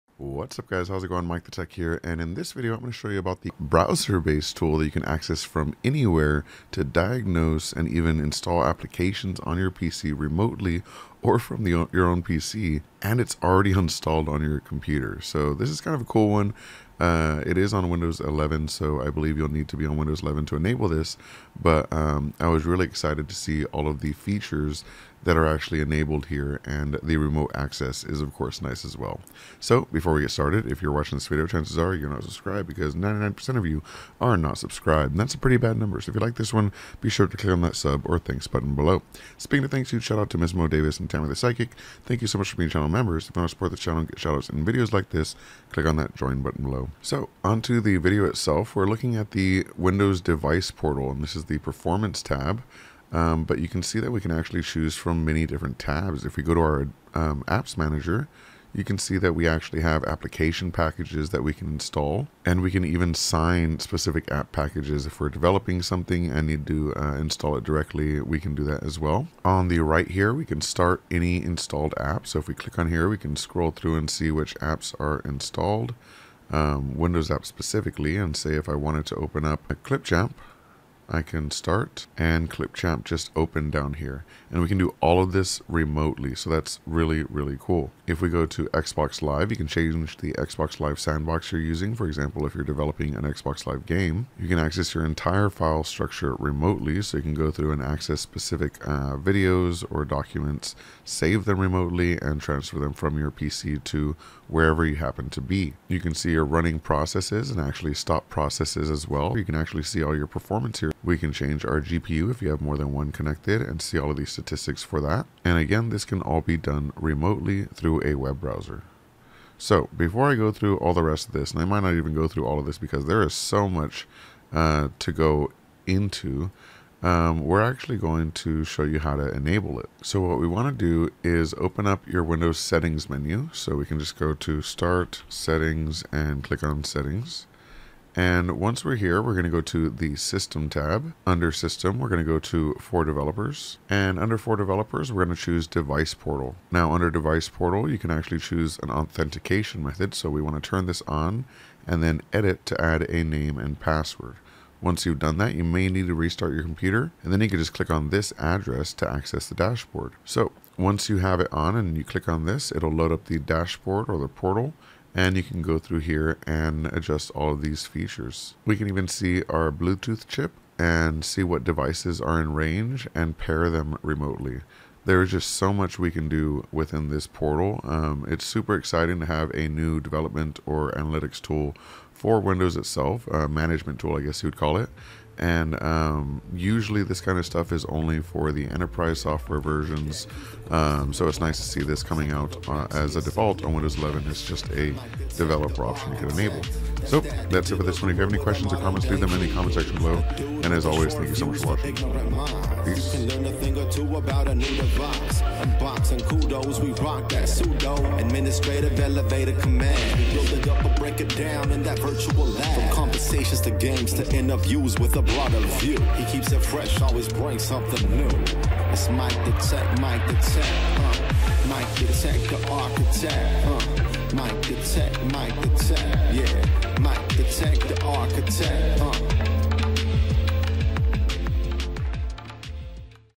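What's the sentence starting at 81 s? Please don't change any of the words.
I can start and Clipchamp just open down here.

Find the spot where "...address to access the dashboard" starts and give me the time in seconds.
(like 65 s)
158 s.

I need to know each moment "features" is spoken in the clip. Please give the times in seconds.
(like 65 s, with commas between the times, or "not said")
24 s, 167 s.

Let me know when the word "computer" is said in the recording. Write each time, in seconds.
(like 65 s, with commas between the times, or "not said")
14 s, 156 s.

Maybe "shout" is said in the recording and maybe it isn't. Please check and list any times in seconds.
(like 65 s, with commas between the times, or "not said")
40 s, 44 s.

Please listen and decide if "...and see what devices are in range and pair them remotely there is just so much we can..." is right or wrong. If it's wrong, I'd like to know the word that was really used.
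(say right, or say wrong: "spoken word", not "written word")
right.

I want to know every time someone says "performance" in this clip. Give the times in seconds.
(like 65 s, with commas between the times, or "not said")
51 s, 110 s.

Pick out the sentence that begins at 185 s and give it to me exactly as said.
And um, usually, this kind of stuff is only for the enterprise software versions.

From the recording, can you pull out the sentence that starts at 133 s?
So we can just go to start settings and click on settings.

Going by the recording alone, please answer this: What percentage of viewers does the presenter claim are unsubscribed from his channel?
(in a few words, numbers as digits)
99%.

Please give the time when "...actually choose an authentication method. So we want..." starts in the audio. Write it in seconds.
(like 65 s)
148 s.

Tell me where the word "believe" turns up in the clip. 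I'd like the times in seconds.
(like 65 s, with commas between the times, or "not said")
19 s.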